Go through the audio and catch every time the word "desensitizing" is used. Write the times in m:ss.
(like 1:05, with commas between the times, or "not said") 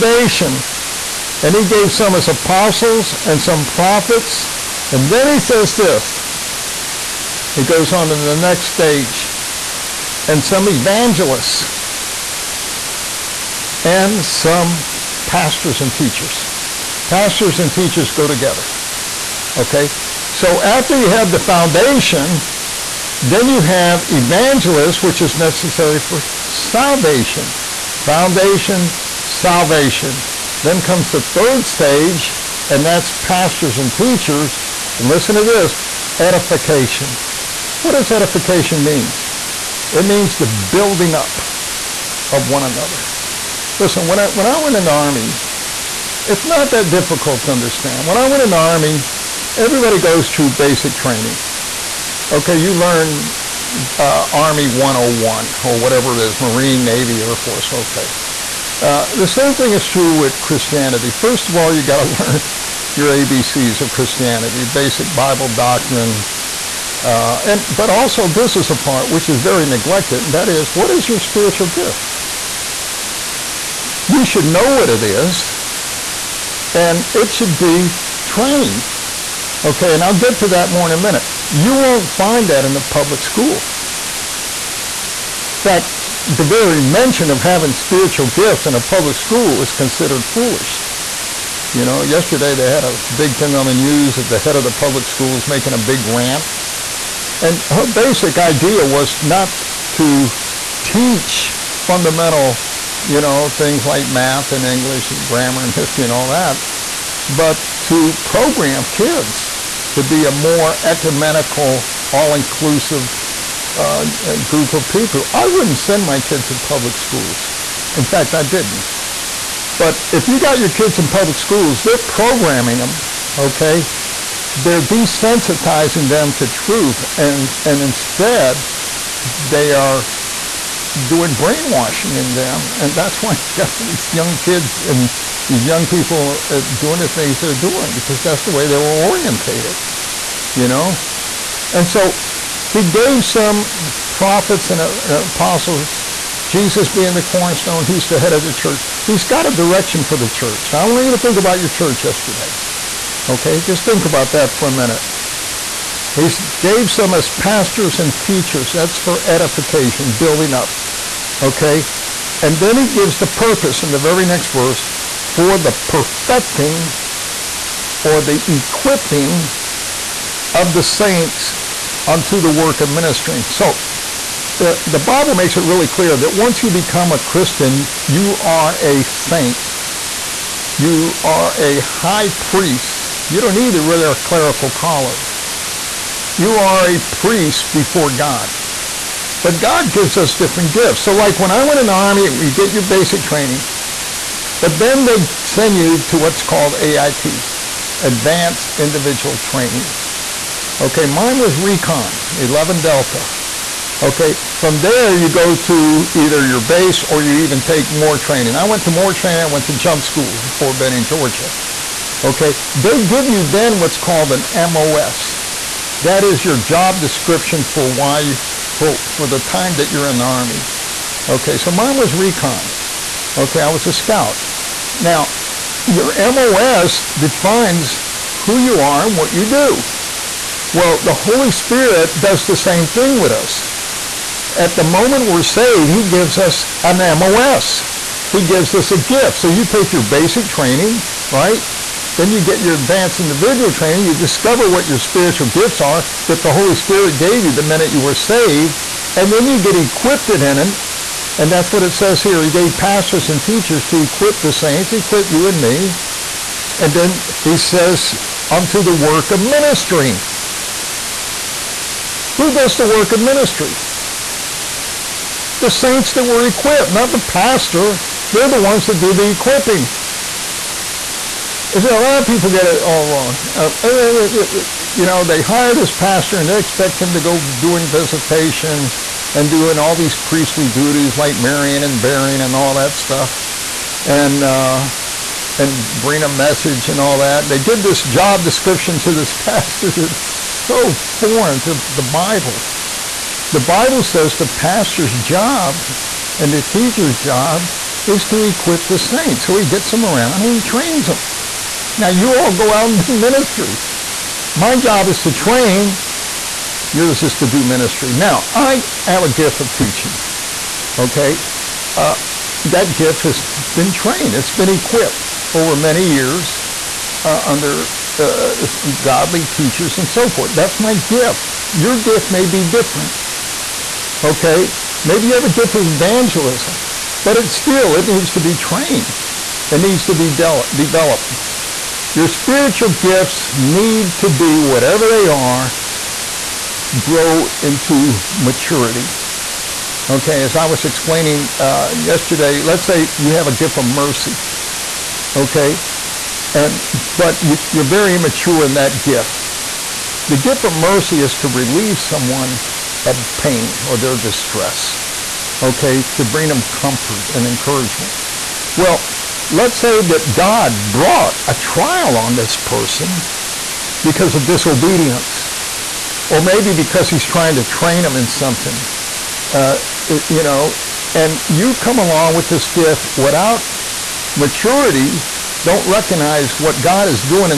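2:04.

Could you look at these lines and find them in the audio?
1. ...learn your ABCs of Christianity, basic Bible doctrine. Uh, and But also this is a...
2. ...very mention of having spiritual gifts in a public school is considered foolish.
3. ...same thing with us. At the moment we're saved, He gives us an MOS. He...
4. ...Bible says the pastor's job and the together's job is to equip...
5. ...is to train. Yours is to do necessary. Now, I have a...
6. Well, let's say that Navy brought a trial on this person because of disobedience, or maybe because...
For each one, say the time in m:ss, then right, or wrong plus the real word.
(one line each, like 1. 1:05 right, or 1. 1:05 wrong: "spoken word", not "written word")
1. 1:02 right
2. 1:26 right
3. 3:52 right
4. 4:53 wrong: "teacher", not "together"
5. 5:05 wrong: "ministry", not "necessary"
6. 5:58 wrong: "God", not "Navy".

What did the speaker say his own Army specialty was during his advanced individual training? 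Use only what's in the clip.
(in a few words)
Recon, 11 Delta.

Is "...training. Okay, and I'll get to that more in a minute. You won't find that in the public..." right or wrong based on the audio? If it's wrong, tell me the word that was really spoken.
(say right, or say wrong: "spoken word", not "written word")
right.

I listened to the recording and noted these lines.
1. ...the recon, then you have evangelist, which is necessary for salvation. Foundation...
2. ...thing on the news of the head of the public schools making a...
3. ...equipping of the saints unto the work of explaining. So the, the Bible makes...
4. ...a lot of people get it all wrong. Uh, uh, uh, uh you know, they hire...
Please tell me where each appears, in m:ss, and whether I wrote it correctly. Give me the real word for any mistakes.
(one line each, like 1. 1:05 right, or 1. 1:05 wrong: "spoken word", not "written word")
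1. 0:21 wrong: "foundation", not "recon"
2. 1:33 right
3. 2:48 wrong: "ministering", not "explaining"
4. 4:31 right.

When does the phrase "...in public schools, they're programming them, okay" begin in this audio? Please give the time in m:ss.
2:00.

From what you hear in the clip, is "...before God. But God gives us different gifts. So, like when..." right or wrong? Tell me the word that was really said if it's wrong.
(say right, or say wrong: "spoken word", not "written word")
right.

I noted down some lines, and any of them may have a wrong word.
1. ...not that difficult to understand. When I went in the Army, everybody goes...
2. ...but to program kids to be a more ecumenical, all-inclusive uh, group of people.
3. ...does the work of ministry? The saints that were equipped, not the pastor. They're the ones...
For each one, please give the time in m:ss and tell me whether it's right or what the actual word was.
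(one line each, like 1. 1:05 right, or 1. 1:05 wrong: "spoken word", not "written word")
1. 0:46 right
2. 1:47 right
3. 4:22 right.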